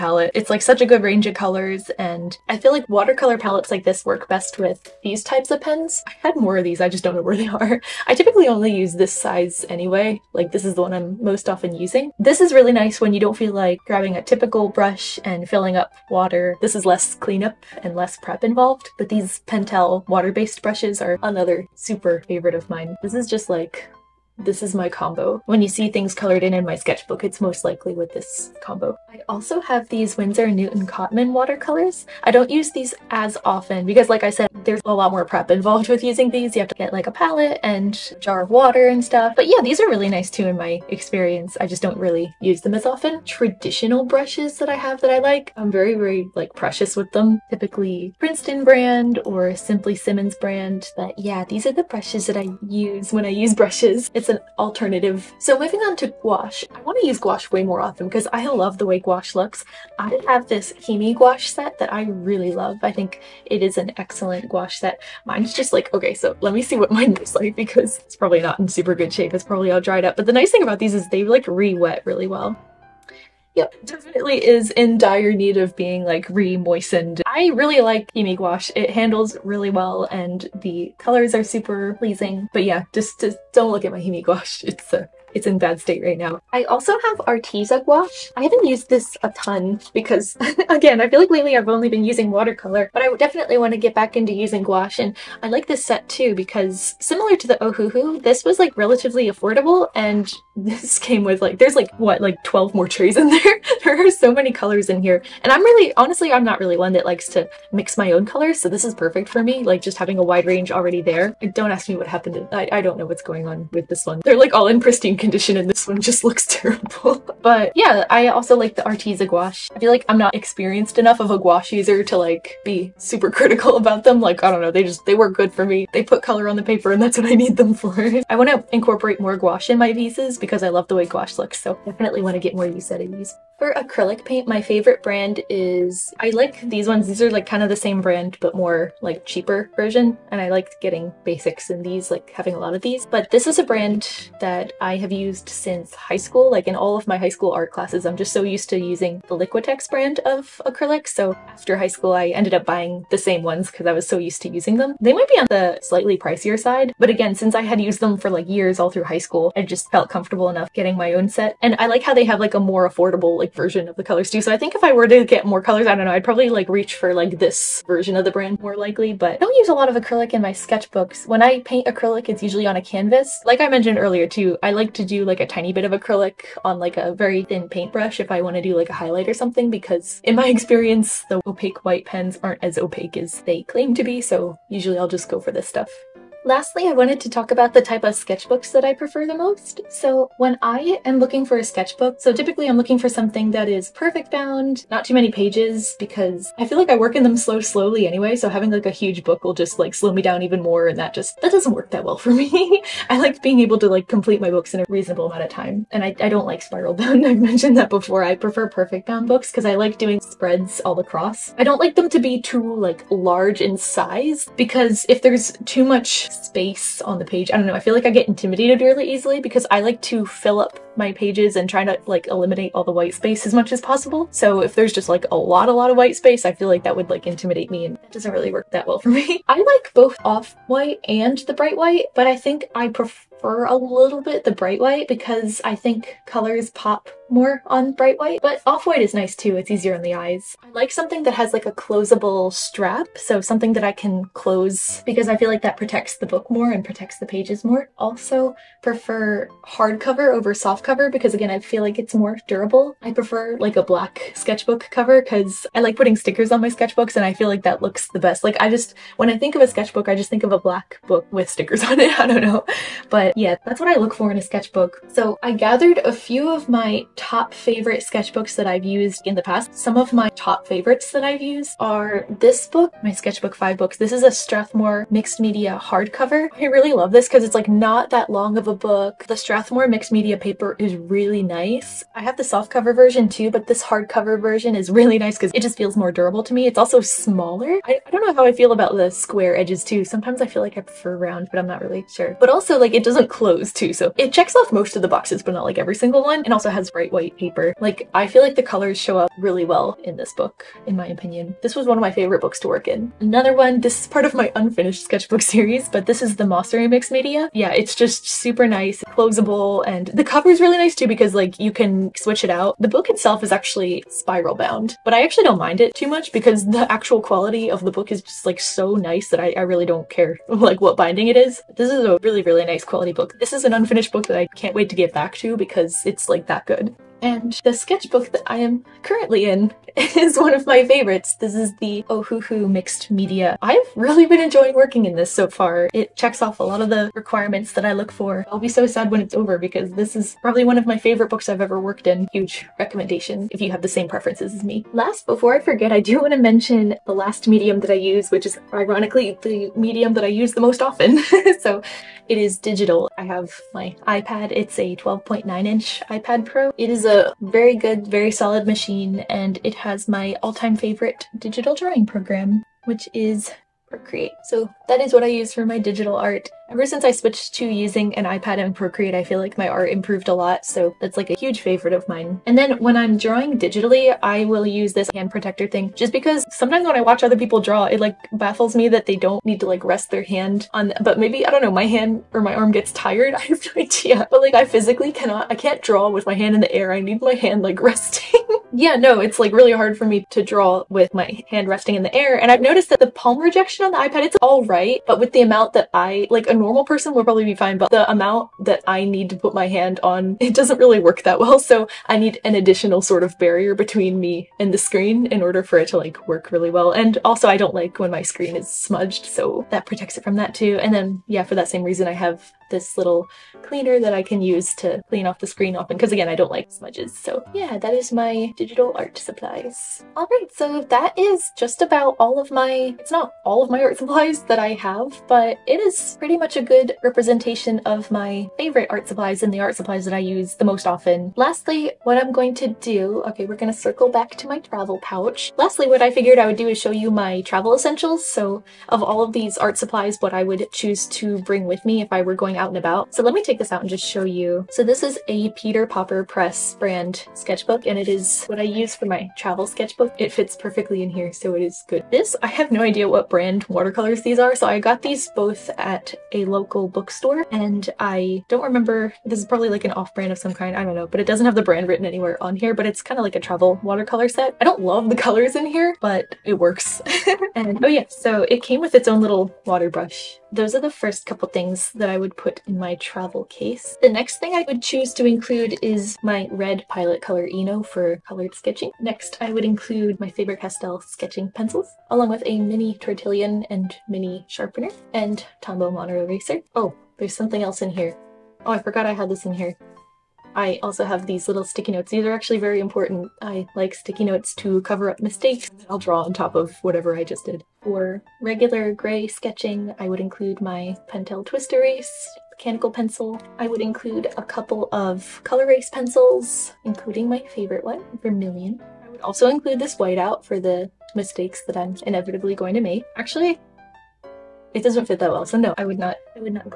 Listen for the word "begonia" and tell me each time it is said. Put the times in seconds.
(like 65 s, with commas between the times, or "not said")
not said.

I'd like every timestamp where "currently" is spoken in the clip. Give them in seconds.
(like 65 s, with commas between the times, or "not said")
329 s.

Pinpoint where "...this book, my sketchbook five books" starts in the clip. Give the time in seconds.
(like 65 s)
272 s.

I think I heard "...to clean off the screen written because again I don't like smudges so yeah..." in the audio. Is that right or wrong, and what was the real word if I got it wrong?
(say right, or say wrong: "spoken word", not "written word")
wrong: "often", not "written".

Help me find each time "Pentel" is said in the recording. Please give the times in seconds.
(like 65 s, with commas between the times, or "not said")
19 s, 501 s.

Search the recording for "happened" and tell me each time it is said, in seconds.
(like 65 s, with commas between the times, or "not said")
112 s.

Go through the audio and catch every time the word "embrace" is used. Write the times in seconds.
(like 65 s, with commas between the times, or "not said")
not said.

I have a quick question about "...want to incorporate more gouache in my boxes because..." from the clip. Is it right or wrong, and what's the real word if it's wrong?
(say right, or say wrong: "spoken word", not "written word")
wrong: "pieces", not "boxes".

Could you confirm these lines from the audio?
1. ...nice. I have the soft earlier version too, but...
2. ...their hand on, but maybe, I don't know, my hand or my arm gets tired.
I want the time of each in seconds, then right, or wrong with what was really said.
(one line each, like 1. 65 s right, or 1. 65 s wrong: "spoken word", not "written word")
1. 281 s wrong: "cover", not "earlier"
2. 380 s right.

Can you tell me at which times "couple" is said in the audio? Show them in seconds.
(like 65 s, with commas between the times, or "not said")
471 s, 504 s.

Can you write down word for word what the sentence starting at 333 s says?
I've really been enjoying working in this so far.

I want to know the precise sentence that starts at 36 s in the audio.
You have to get like a palette and jar of water and stuff.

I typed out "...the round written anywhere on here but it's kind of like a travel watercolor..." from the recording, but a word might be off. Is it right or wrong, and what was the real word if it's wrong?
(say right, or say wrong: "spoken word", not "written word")
wrong: "brand", not "round".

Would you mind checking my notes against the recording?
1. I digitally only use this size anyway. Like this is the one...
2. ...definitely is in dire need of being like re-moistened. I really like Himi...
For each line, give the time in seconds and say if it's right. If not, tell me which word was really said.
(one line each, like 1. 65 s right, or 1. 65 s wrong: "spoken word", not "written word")
1. 8 s wrong: "typically", not "digitally"
2. 73 s right.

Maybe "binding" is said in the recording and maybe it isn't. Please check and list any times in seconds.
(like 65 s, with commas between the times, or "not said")
320 s.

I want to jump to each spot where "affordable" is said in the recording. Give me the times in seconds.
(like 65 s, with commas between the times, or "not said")
99 s, 162 s.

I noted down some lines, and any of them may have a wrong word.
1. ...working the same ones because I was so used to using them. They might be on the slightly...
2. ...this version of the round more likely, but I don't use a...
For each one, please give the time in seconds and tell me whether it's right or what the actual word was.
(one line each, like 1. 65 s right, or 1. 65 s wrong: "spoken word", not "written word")
1. 152 s wrong: "buying", not "working"
2. 167 s wrong: "brand", not "round".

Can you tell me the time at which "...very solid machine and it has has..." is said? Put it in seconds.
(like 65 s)
358 s.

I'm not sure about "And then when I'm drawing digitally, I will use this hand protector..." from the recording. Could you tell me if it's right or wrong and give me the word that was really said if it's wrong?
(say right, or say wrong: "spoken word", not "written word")
right.